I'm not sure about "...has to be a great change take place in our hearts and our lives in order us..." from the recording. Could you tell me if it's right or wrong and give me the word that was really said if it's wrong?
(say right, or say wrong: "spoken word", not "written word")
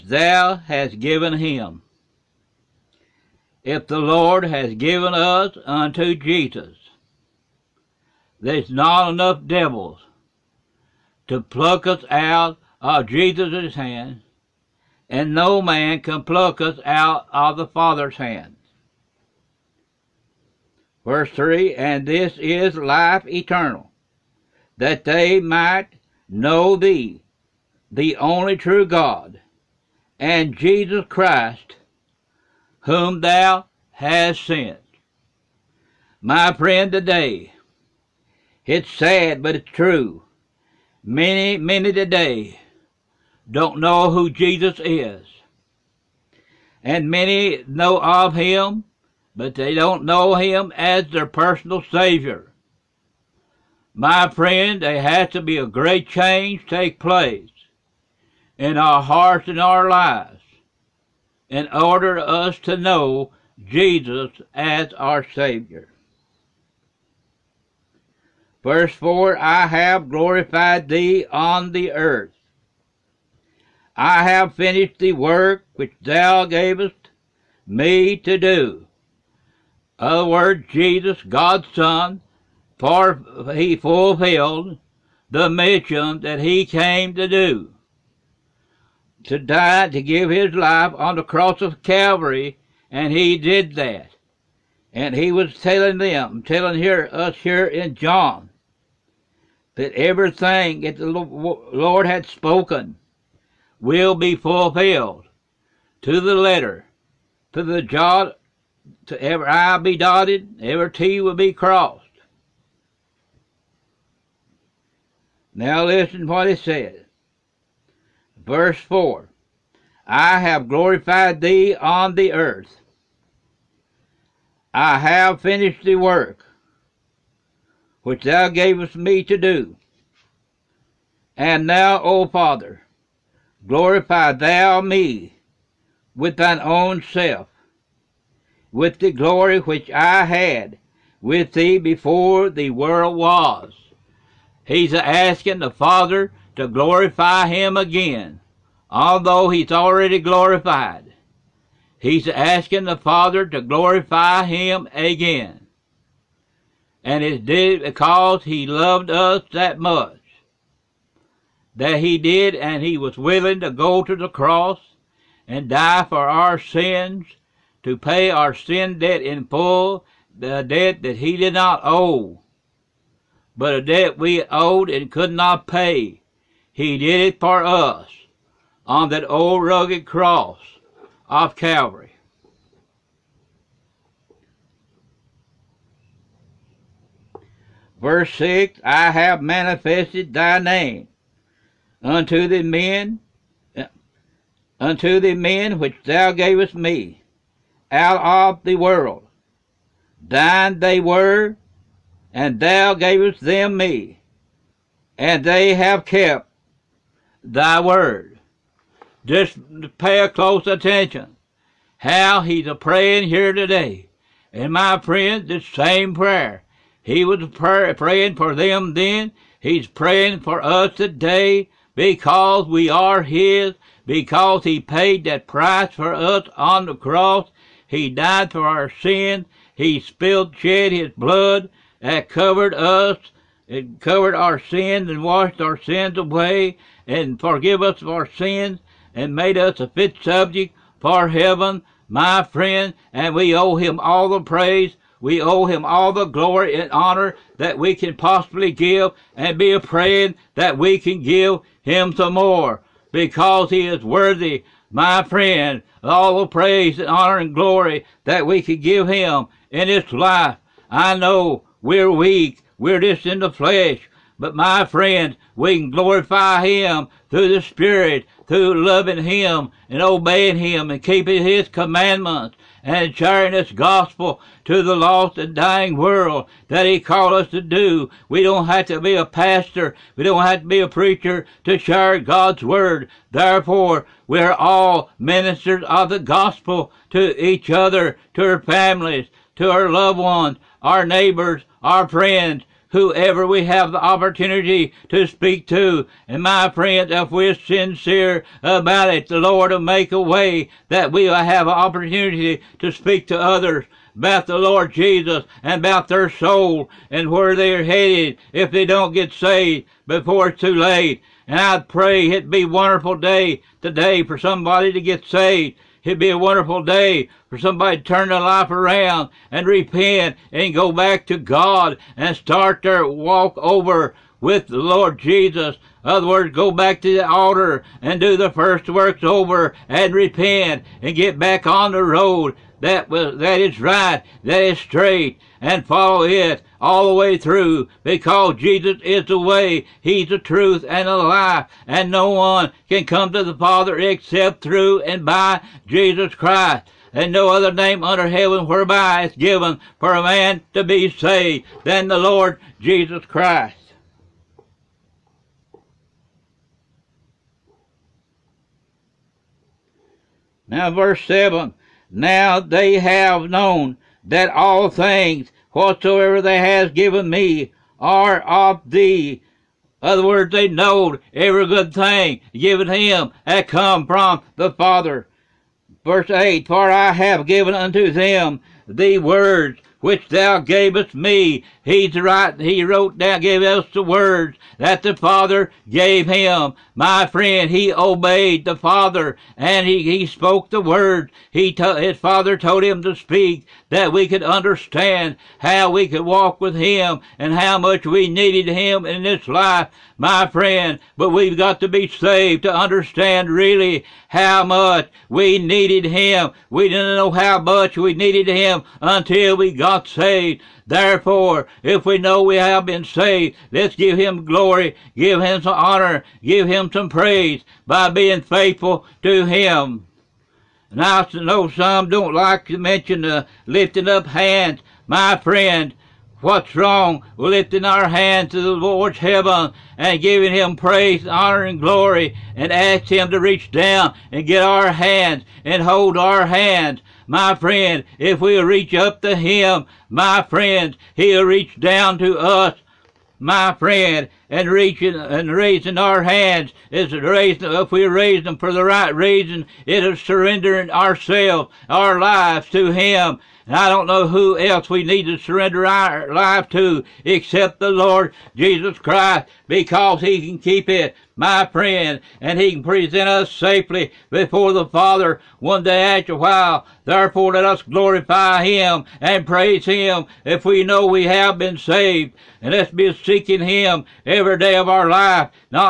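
right.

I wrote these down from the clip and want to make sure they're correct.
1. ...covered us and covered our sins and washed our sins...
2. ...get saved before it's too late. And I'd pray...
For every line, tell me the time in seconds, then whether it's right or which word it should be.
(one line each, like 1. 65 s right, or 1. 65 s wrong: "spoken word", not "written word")
1. 232 s right
2. 309 s right.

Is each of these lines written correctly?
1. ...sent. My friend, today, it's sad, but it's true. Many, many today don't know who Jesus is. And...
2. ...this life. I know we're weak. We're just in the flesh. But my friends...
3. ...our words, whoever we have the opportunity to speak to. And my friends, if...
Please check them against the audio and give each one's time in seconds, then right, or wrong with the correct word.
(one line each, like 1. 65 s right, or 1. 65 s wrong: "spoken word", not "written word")
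1. 34 s right
2. 259 s right
3. 291 s wrong: "friends", not "words".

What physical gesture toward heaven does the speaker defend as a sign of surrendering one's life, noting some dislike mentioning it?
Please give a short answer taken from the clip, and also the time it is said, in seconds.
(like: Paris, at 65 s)
lifting up hands, at 423 s.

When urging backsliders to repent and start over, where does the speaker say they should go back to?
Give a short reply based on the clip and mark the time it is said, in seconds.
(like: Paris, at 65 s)
the altar, at 327 s.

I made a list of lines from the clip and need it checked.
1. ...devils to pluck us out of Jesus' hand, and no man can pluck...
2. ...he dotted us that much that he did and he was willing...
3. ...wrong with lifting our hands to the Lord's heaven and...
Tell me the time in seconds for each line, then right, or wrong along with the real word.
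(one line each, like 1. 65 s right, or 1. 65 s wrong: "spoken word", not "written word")
1. 9 s right
2. 158 s wrong: "loved", not "dotted"
3. 426 s right.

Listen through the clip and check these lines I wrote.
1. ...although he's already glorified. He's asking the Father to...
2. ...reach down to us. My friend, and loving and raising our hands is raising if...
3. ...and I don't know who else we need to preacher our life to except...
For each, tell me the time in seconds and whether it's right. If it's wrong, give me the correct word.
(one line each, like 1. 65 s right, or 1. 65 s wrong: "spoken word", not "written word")
1. 148 s right
2. 441 s wrong: "reaching", not "loving"
3. 453 s wrong: "surrender", not "preacher".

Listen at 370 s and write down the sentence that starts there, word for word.
Other words, they knowed every good thing given him had come from the Father.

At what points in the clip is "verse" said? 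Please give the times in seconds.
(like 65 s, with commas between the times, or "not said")
21 s, 68 s, 118 s, 187 s, 360 s, 376 s.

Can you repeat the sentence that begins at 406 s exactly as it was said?
We didn't know how much we needed him until we got saved.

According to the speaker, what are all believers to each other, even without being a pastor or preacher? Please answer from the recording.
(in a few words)
ministers of the gospel.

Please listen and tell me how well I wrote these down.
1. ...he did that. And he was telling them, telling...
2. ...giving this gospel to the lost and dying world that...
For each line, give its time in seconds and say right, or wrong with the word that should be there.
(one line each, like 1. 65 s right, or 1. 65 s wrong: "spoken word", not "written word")
1. 93 s right
2. 273 s wrong: "sharing", not "giving".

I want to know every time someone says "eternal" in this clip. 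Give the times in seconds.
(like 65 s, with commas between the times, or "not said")
23 s.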